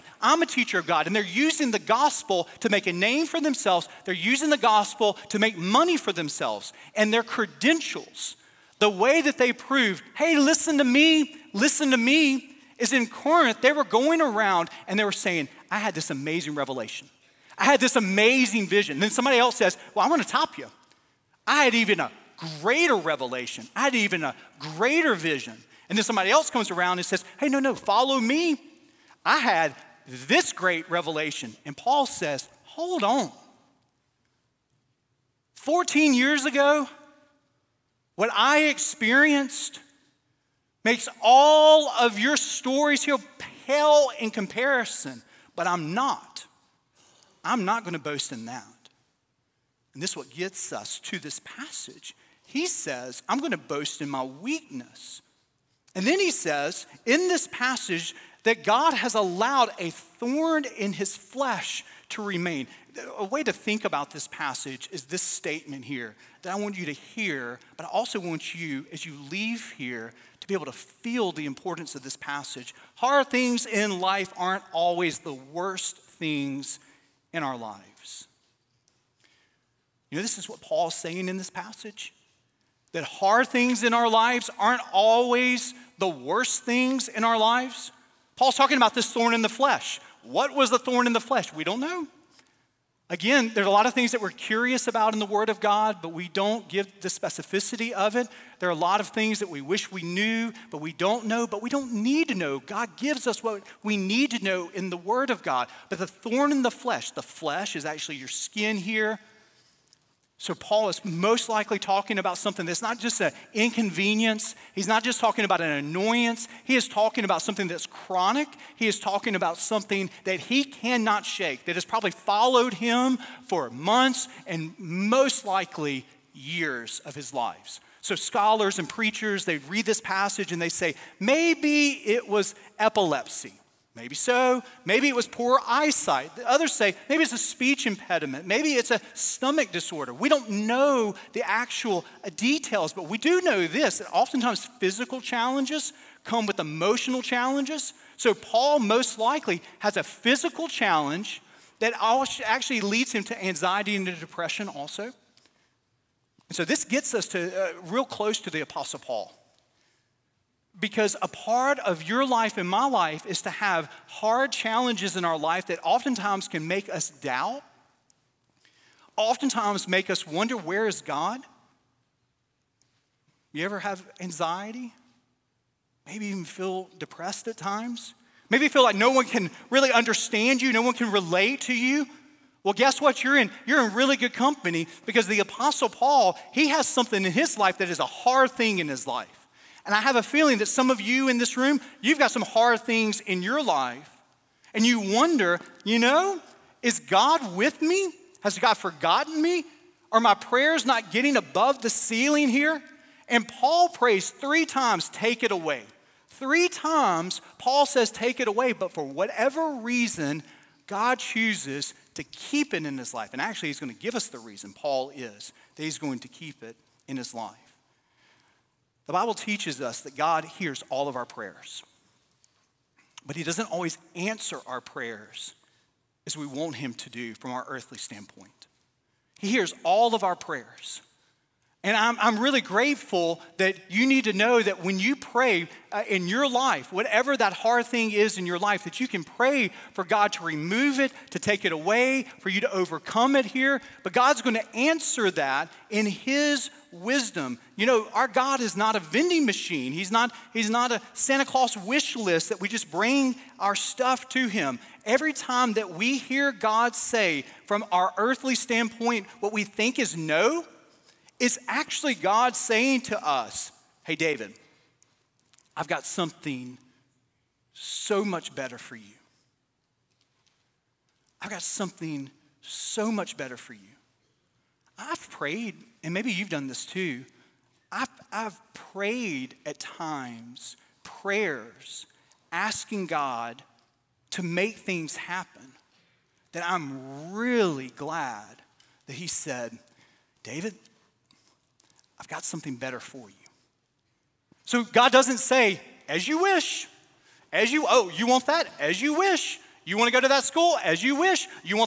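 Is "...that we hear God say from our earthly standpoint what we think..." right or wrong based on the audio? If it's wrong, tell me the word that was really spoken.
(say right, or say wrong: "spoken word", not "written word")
right.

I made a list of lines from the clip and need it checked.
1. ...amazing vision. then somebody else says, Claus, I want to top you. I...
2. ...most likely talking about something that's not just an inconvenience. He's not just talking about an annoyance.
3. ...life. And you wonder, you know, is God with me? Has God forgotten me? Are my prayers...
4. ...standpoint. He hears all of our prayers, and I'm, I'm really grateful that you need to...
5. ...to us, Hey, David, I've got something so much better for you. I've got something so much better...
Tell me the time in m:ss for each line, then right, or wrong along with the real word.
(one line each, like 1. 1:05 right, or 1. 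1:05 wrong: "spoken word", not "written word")
1. 0:17 wrong: "Well", not "Claus"
2. 1:51 right
3. 3:13 right
4. 3:47 right
5. 4:23 right.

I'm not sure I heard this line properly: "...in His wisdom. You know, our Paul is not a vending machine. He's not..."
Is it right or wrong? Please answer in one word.
wrong.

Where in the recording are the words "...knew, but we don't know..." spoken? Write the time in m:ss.
1:40.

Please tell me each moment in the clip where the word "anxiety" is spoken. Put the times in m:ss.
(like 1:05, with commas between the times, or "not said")
2:33, 2:54.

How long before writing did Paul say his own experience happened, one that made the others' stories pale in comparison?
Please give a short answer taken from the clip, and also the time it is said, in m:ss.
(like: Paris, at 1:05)
14 years, at 0:35.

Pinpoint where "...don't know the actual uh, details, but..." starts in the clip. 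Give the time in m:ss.
2:20.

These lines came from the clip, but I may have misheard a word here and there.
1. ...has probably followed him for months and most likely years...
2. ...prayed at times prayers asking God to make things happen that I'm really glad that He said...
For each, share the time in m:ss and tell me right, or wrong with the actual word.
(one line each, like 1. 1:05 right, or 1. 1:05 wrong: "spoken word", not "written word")
1. 2:01 right
2. 4:38 right.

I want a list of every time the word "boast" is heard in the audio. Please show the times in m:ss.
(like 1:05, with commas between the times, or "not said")
0:47, 0:53.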